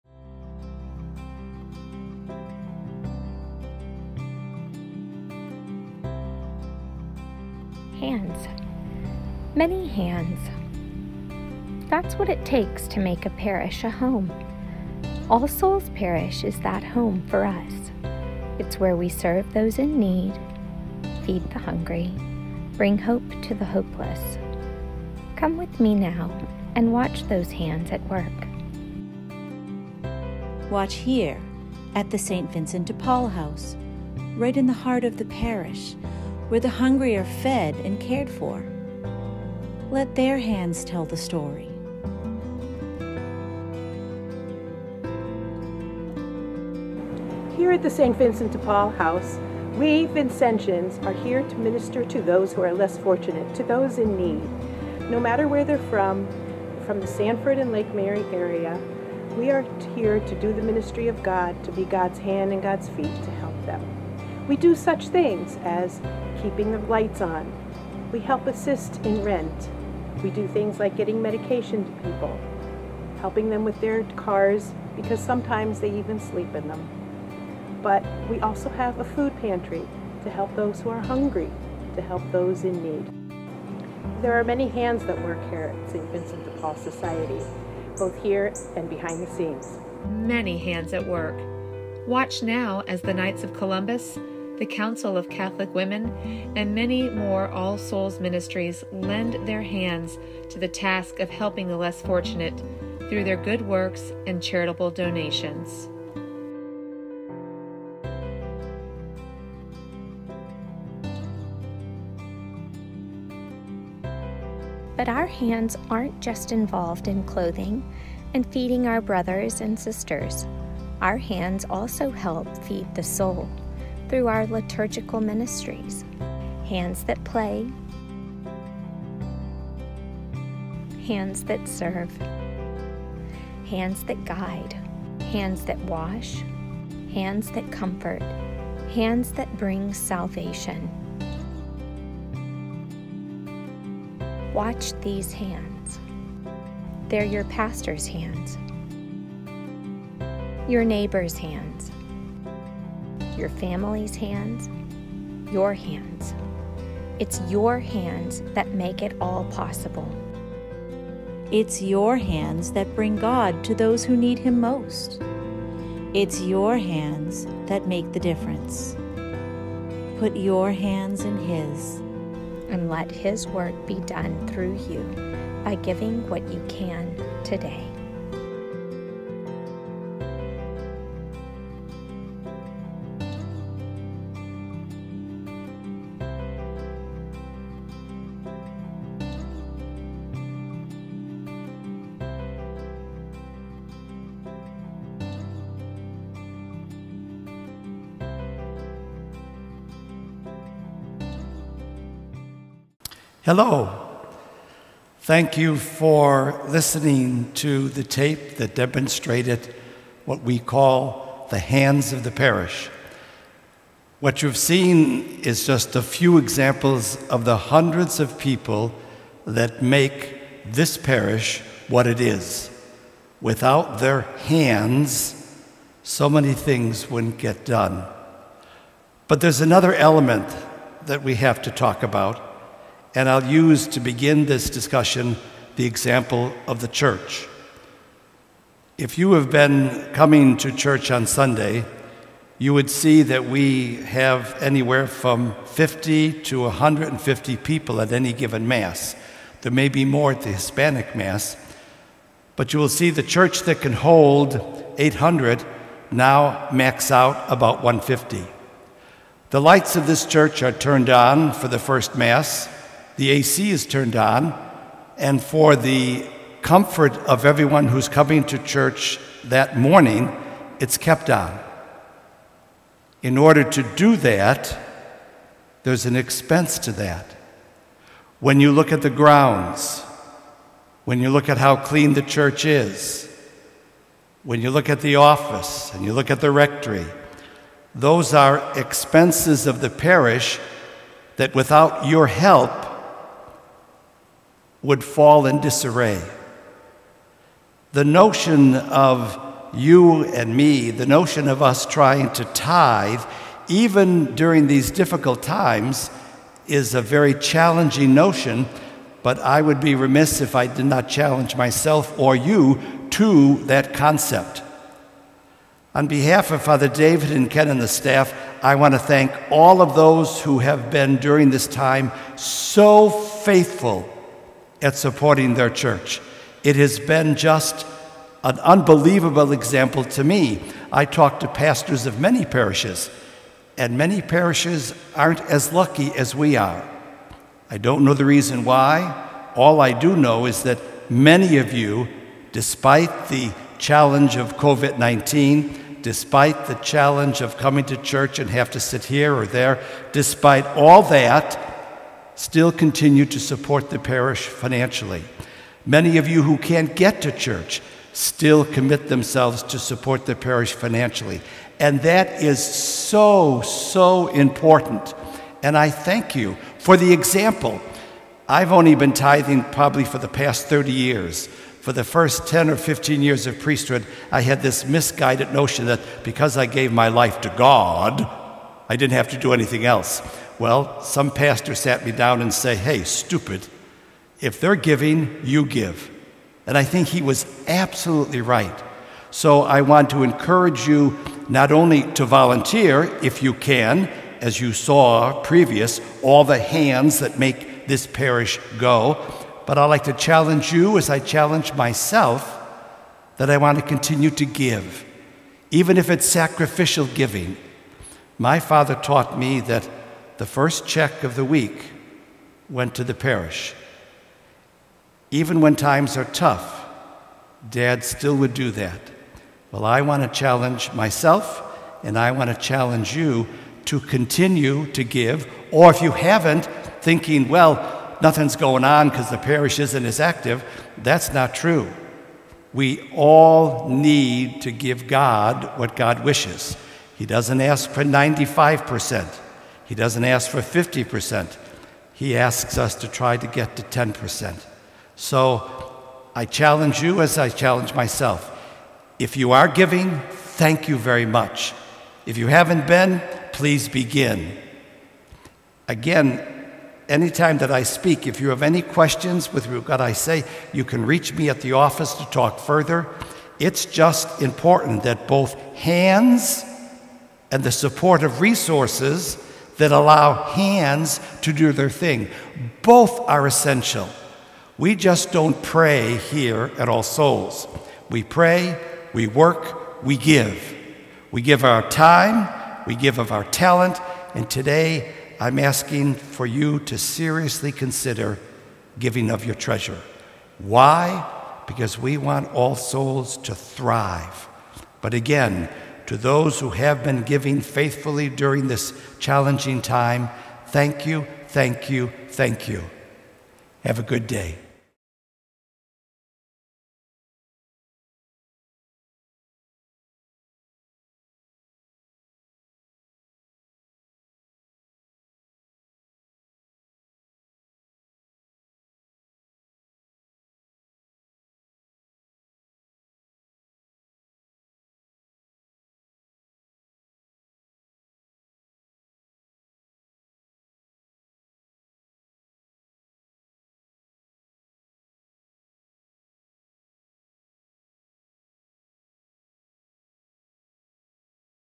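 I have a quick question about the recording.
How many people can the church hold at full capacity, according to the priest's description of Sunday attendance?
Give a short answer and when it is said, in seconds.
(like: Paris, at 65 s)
800, at 254 s.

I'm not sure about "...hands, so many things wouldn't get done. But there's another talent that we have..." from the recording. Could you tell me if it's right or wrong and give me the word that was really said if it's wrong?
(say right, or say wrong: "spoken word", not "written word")
wrong: "element", not "talent".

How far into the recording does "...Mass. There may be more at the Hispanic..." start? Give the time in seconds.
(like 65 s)
248 s.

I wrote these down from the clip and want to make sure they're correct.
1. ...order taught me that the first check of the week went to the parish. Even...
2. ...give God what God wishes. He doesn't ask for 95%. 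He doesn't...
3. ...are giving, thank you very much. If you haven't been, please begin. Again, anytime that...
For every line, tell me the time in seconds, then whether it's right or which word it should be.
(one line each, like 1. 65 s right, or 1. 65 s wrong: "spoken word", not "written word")
1. 408 s wrong: "father", not "order"
2. 434 s right
3. 449 s right.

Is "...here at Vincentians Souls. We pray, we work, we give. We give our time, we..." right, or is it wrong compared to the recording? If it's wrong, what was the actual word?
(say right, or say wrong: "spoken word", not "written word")
wrong: "All", not "Vincentians".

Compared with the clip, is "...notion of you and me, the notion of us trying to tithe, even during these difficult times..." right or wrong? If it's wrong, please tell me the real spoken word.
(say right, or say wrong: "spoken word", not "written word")
right.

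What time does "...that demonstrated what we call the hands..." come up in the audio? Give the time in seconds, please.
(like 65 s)
208 s.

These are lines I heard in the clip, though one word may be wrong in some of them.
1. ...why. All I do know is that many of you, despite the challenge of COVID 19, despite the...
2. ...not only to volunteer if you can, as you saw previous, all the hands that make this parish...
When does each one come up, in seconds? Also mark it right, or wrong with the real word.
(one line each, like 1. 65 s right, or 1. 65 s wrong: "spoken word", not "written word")
1. 338 s right
2. 391 s right.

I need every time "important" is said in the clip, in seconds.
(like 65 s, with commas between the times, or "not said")
364 s, 464 s.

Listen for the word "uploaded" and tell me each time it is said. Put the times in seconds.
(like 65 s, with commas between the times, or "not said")
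not said.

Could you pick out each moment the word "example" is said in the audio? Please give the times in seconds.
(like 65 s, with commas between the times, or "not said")
216 s, 235 s, 329 s, 367 s.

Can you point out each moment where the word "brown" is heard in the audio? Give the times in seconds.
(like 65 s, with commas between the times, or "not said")
not said.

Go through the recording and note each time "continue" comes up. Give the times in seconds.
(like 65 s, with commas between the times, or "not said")
352 s, 403 s, 423 s.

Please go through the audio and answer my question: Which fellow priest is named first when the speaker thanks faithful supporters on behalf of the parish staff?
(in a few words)
Father David.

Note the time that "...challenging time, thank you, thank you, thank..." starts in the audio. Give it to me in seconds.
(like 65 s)
499 s.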